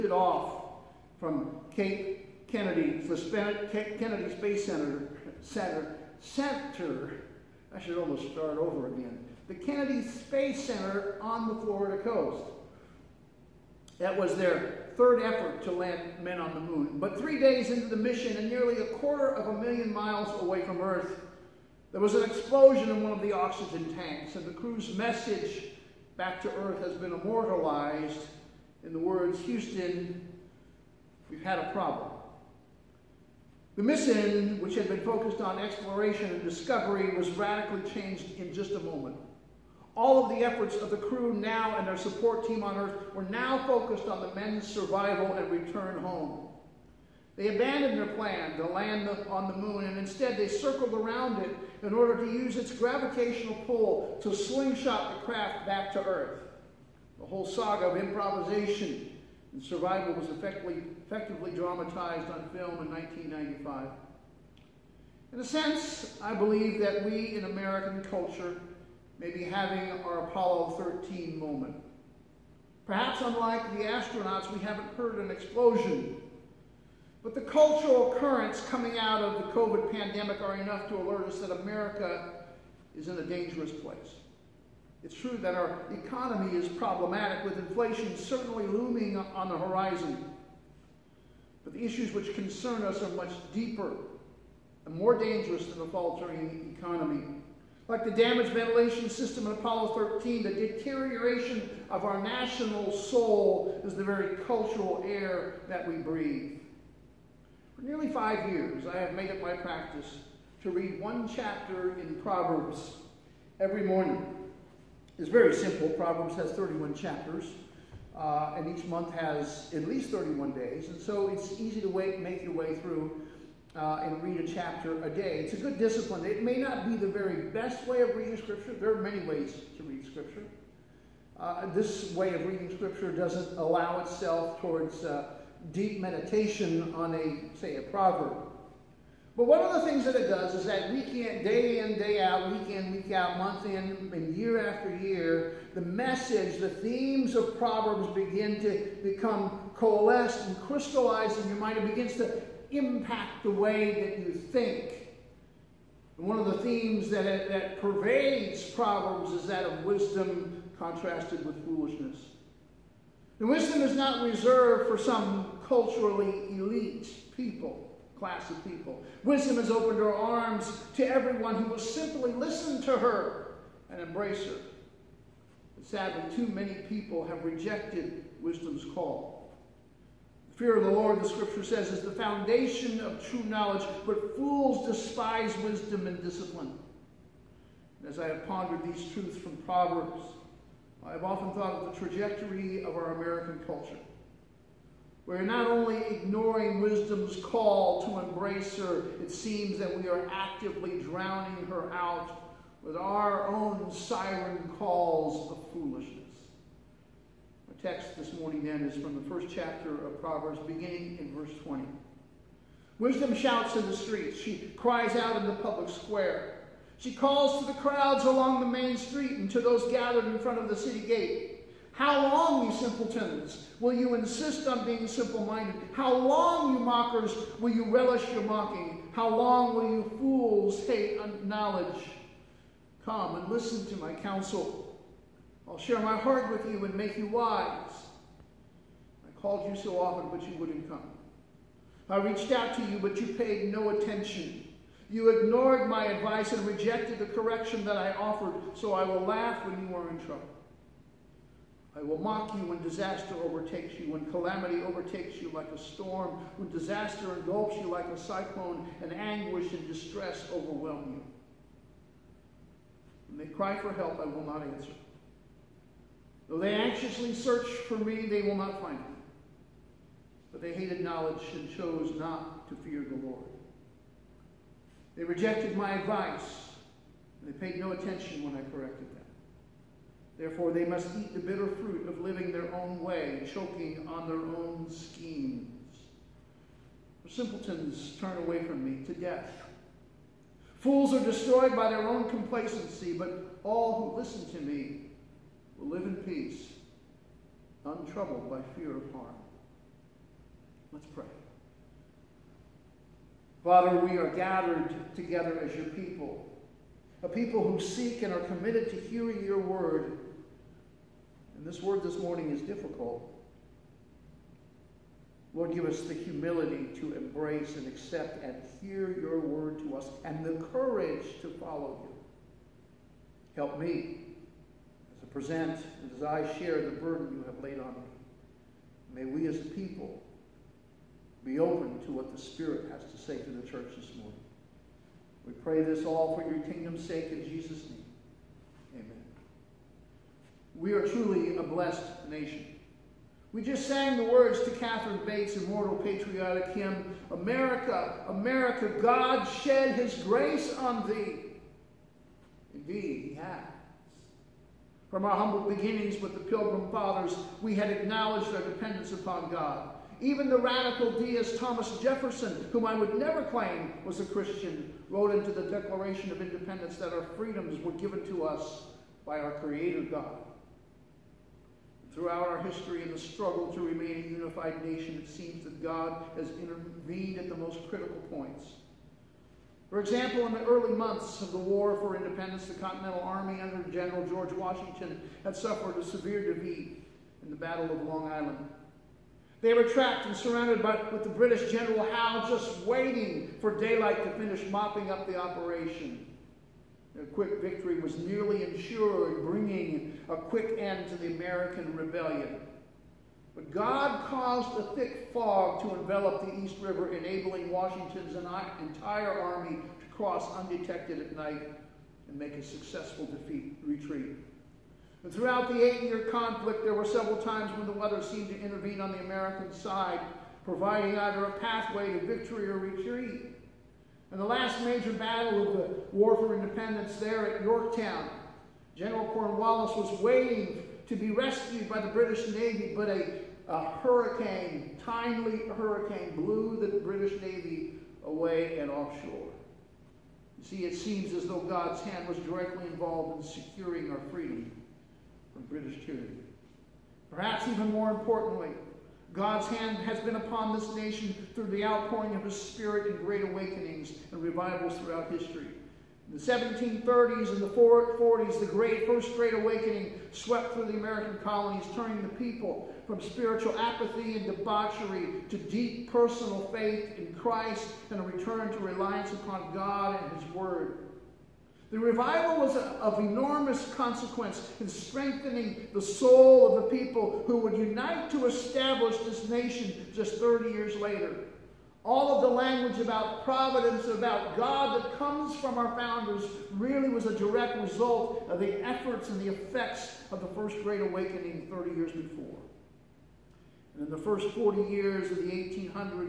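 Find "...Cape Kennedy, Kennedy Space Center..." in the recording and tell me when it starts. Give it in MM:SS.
00:01.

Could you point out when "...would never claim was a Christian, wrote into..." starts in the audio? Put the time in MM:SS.
06:02.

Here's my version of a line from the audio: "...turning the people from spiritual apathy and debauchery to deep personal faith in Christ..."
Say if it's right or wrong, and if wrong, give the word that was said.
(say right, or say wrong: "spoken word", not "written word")
right.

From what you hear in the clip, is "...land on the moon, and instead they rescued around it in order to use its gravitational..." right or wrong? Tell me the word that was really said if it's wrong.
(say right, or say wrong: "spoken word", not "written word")
wrong: "circled", not "rescued".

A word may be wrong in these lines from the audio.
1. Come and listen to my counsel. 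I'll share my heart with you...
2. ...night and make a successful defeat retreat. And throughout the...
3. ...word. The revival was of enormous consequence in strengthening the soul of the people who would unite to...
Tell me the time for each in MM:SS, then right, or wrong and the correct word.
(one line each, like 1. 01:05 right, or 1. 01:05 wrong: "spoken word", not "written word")
1. 03:53 right
2. 06:51 right
3. 07:50 right.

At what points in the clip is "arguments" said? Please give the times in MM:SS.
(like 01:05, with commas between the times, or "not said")
not said.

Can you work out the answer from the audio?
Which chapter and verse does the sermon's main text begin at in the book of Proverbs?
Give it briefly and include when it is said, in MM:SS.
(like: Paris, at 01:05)
Chapter 1, verse 20, at 03:29.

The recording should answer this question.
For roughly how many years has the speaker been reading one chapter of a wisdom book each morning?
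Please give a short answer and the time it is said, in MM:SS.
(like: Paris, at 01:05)
5, at 01:48.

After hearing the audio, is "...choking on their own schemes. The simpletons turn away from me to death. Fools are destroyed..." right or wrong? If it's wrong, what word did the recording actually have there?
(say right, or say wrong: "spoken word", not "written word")
right.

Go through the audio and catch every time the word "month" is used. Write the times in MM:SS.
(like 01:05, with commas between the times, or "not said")
01:58, 02:23, 06:20.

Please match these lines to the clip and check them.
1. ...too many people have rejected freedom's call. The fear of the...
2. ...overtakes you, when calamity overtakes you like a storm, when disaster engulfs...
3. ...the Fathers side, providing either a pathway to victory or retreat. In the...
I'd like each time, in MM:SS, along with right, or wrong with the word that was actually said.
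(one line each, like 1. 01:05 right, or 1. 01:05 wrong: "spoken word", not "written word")
1. 02:56 wrong: "wisdom", not "freedom"
2. 04:13 right
3. 06:59 wrong: "American", not "Fathers".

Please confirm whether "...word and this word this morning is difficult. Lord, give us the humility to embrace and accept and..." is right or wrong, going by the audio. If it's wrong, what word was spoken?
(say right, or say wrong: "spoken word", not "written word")
right.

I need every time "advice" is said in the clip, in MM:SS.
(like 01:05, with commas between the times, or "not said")
04:06, 04:35.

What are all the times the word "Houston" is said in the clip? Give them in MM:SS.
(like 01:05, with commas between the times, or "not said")
00:29.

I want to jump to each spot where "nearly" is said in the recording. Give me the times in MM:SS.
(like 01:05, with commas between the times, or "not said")
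00:18, 01:47, 06:38.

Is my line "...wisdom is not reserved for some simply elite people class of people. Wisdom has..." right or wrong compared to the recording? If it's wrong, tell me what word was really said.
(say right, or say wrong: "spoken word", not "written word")
wrong: "culturally", not "simply".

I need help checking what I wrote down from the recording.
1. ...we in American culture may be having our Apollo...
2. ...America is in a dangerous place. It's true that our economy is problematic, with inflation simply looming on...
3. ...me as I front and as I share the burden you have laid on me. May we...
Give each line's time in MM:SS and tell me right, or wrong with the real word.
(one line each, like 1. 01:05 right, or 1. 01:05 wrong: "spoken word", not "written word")
1. 01:07 right
2. 01:21 wrong: "certainly", not "simply"
3. 05:23 wrong: "present", not "front".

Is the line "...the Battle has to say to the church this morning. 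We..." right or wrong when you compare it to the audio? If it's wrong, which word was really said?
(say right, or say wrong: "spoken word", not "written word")
wrong: "Spirit", not "Battle".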